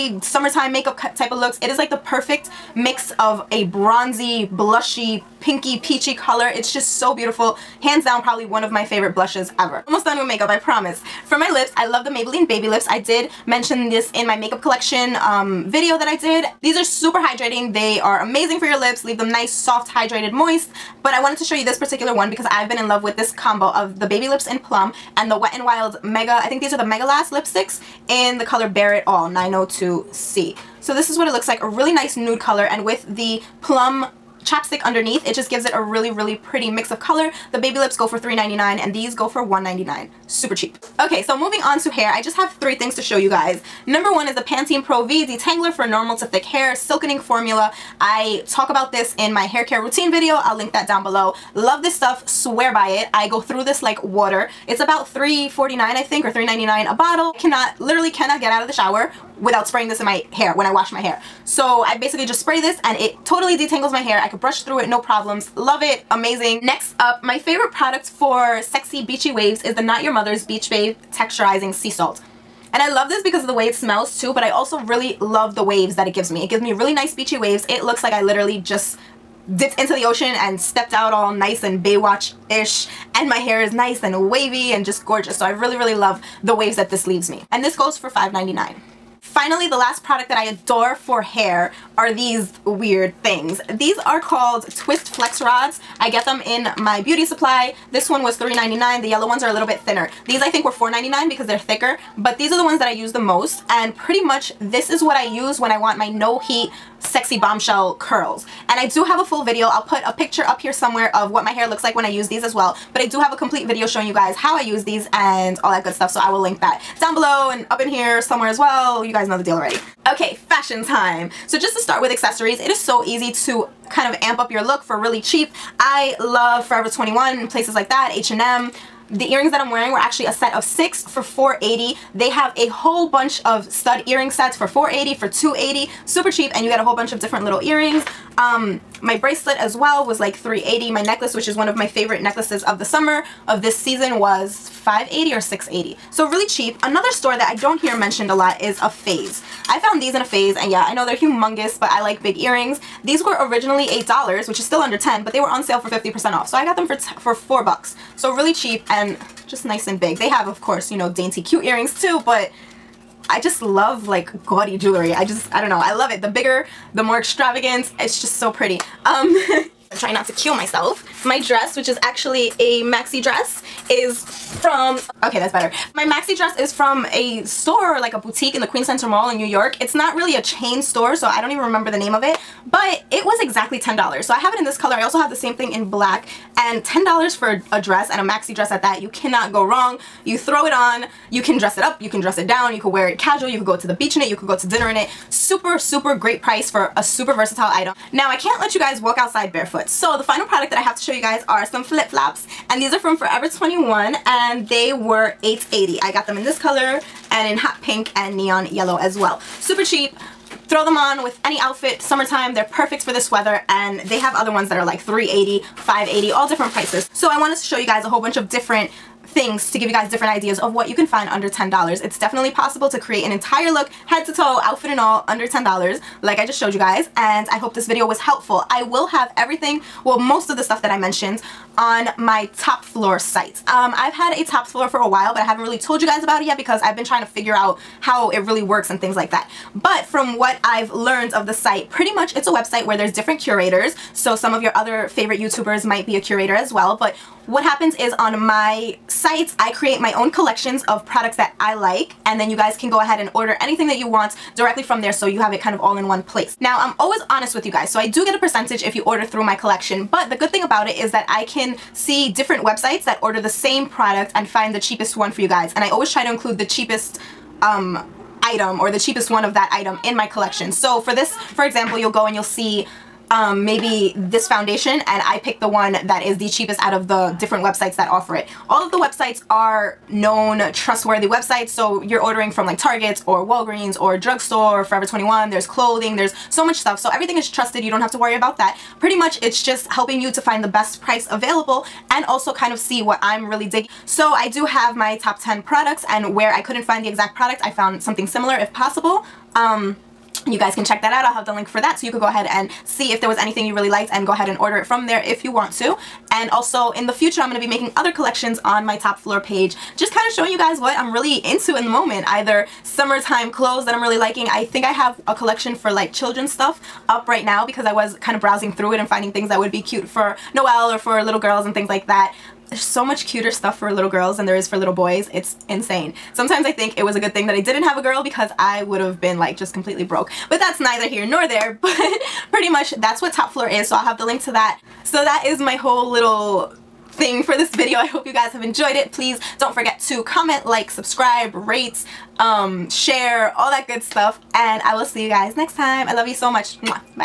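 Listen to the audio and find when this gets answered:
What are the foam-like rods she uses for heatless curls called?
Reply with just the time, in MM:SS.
01:34.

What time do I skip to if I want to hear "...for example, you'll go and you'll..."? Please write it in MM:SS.
04:31.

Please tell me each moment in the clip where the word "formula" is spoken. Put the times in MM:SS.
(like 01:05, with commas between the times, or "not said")
00:47.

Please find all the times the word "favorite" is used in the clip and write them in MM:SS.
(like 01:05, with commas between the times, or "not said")
00:08, 01:07, 02:21, 04:05.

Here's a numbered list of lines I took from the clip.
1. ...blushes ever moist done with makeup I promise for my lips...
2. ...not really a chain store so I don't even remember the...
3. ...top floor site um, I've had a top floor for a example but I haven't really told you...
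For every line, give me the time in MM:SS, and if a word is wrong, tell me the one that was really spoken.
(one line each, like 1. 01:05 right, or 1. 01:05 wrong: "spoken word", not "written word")
1. 00:09 wrong: "almost", not "moist"
2. 02:59 right
3. 03:52 wrong: "while", not "example".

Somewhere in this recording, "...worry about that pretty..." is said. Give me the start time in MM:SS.
04:48.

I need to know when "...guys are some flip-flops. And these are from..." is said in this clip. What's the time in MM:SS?
03:21.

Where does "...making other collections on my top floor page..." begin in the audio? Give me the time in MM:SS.
05:07.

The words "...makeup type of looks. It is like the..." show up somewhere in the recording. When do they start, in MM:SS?
00:00.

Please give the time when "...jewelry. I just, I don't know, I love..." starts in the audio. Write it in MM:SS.
02:44.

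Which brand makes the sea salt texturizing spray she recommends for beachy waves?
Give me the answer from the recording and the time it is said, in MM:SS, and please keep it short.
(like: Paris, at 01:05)
Not Your Mother's, at 01:09.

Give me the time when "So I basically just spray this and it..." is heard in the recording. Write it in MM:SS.
01:01.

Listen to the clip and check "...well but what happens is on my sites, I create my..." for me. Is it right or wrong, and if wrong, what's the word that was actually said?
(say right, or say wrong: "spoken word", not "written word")
right.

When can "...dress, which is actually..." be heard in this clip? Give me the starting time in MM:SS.
02:51.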